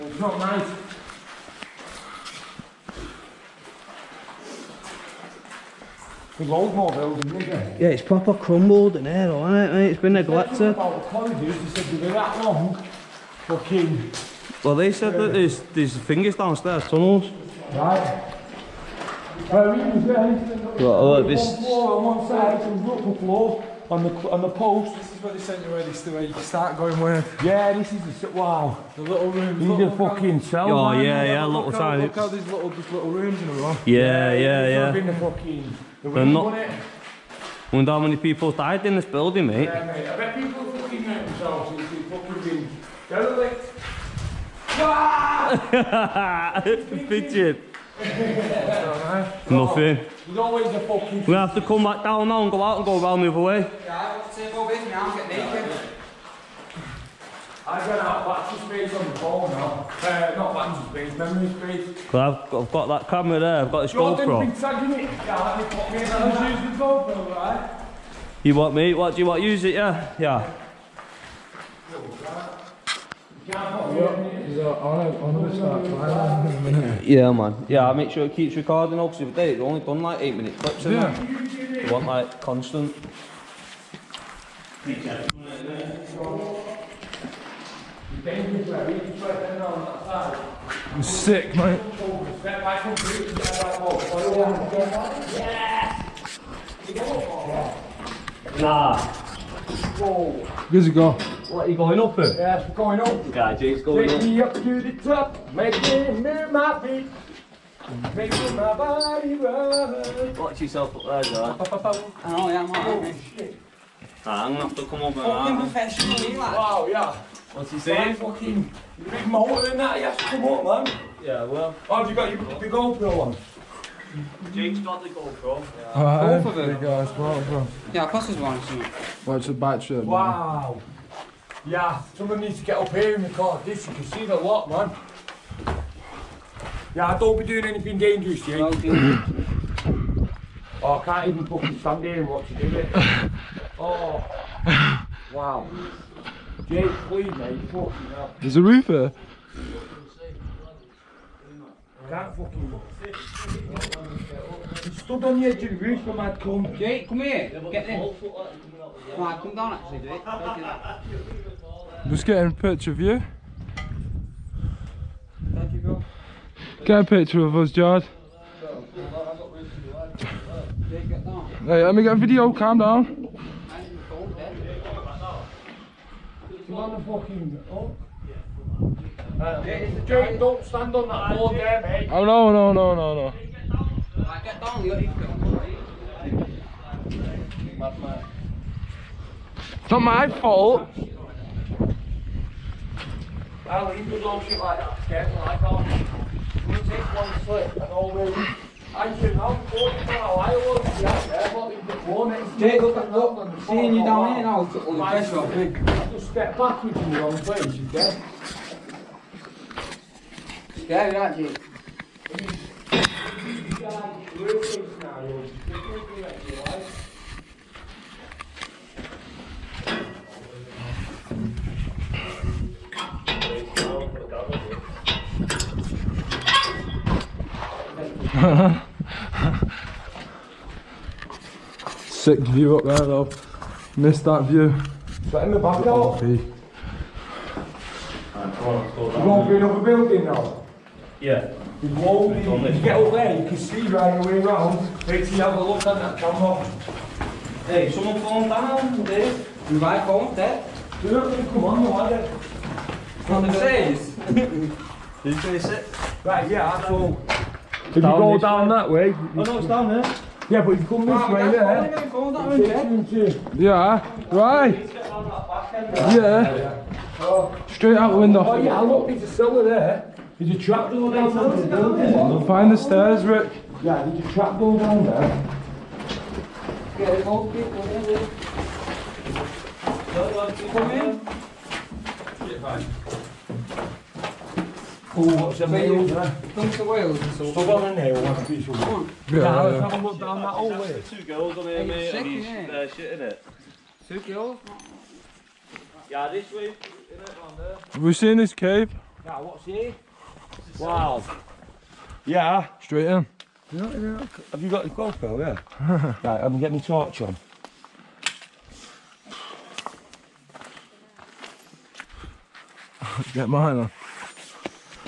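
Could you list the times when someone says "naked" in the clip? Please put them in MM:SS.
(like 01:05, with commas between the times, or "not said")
00:55.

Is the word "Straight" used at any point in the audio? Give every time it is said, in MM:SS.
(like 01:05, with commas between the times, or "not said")
04:27, 05:02.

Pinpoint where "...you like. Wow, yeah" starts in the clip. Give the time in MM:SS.
01:56.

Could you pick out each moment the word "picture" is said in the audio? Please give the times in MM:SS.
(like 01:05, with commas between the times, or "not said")
02:42, 02:47.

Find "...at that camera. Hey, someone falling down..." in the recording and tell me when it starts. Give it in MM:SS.
04:05.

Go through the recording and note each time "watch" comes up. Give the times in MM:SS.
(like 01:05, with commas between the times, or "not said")
01:50, 02:09, 02:22.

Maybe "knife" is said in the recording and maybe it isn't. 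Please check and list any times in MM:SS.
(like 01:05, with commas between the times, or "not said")
not said.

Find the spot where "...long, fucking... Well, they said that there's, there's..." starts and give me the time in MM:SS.
00:12.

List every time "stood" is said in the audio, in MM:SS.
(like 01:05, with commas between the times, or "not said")
02:34.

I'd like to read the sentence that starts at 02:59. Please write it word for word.
Uh, don't stand on that board there, mate.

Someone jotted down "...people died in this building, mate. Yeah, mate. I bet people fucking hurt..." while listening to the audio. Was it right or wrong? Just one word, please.
right.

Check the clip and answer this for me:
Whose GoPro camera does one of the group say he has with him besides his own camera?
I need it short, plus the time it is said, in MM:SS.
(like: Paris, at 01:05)
Jordan's, at 01:03.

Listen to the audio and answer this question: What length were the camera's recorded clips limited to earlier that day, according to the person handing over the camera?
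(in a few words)
8 minutes.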